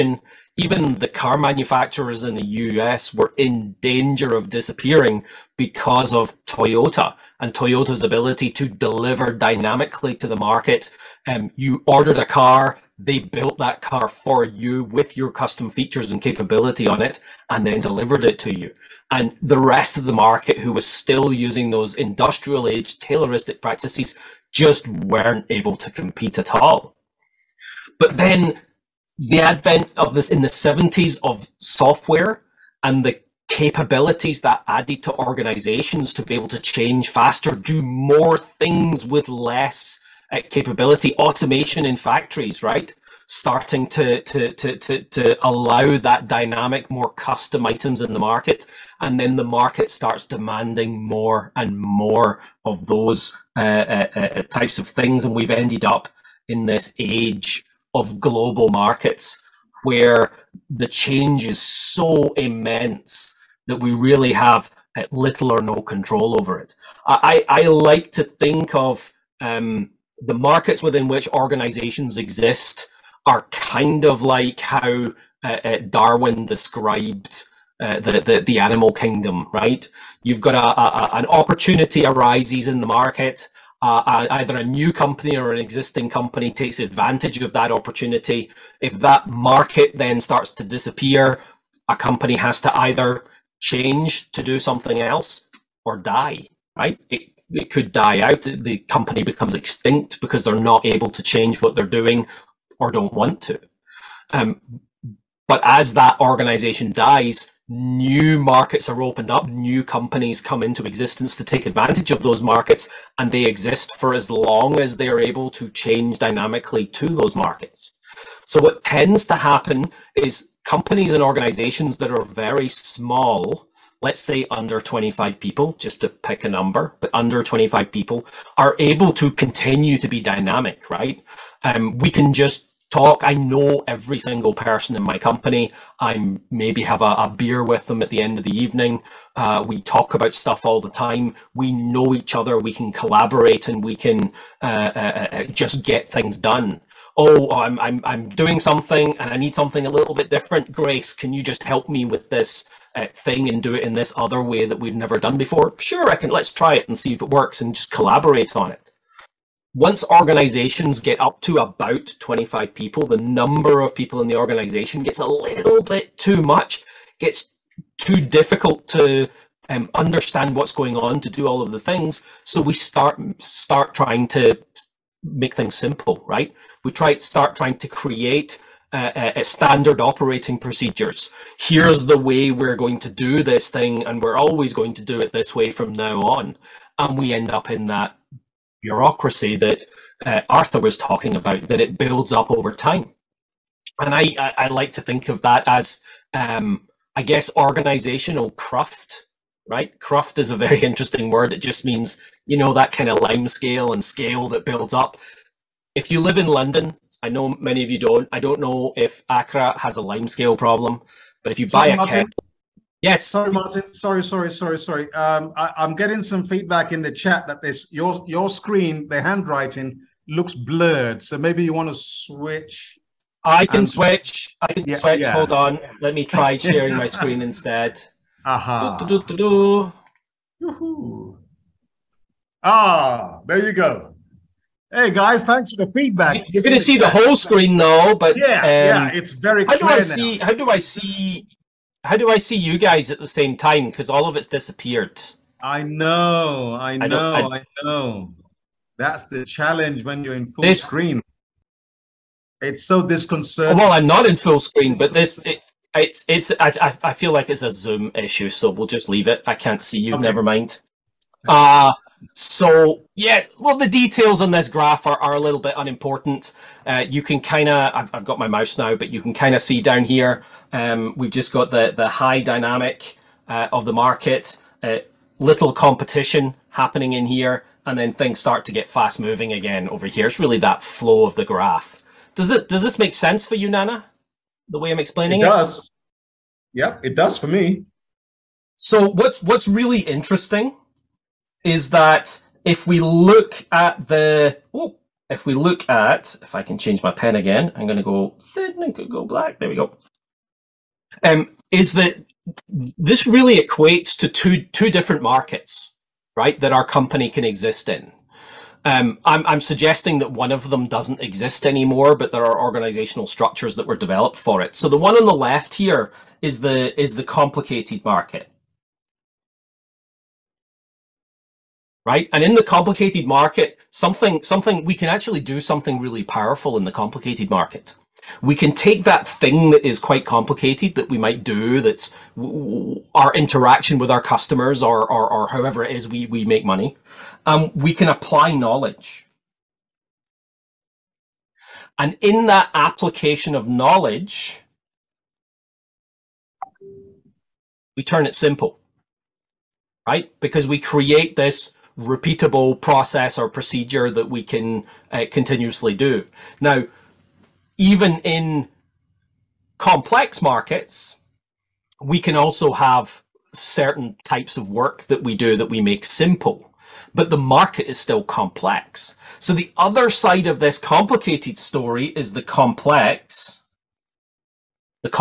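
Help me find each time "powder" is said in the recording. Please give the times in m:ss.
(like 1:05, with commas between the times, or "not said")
not said.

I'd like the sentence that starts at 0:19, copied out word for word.
And the rest of the market, who was still using those industrial age Tayloristic practices, just weren't able to compete at all.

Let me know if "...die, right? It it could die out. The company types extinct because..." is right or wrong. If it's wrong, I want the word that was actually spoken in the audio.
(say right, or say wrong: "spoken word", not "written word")
wrong: "becomes", not "types".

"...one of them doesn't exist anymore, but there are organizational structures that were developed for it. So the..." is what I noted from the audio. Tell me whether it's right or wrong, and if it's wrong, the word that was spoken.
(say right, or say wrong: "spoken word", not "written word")
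right.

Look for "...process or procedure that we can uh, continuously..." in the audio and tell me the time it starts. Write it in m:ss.
5:52.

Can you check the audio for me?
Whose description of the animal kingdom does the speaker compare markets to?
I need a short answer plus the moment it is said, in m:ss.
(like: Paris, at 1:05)
Darwin, at 1:15.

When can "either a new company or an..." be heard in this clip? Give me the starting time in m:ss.
1:23.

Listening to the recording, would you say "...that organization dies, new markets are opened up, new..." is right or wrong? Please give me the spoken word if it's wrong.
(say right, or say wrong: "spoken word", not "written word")
right.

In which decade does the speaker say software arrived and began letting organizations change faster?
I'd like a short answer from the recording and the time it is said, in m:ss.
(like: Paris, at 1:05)
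1970s, at 0:30.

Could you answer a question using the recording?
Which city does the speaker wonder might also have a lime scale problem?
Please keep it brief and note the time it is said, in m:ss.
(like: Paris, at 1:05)
Accra, at 3:29.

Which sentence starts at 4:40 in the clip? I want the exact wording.
It's really that flow of the graph.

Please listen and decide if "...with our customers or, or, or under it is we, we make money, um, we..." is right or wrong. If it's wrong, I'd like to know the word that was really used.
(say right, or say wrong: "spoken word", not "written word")
wrong: "however", not "under".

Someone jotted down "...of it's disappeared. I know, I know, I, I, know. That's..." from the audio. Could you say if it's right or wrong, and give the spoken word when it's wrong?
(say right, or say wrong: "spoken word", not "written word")
right.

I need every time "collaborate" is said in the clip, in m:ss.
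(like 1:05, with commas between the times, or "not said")
2:22, 2:37.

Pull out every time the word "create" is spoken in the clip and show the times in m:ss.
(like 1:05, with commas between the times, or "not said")
2:57, 5:50.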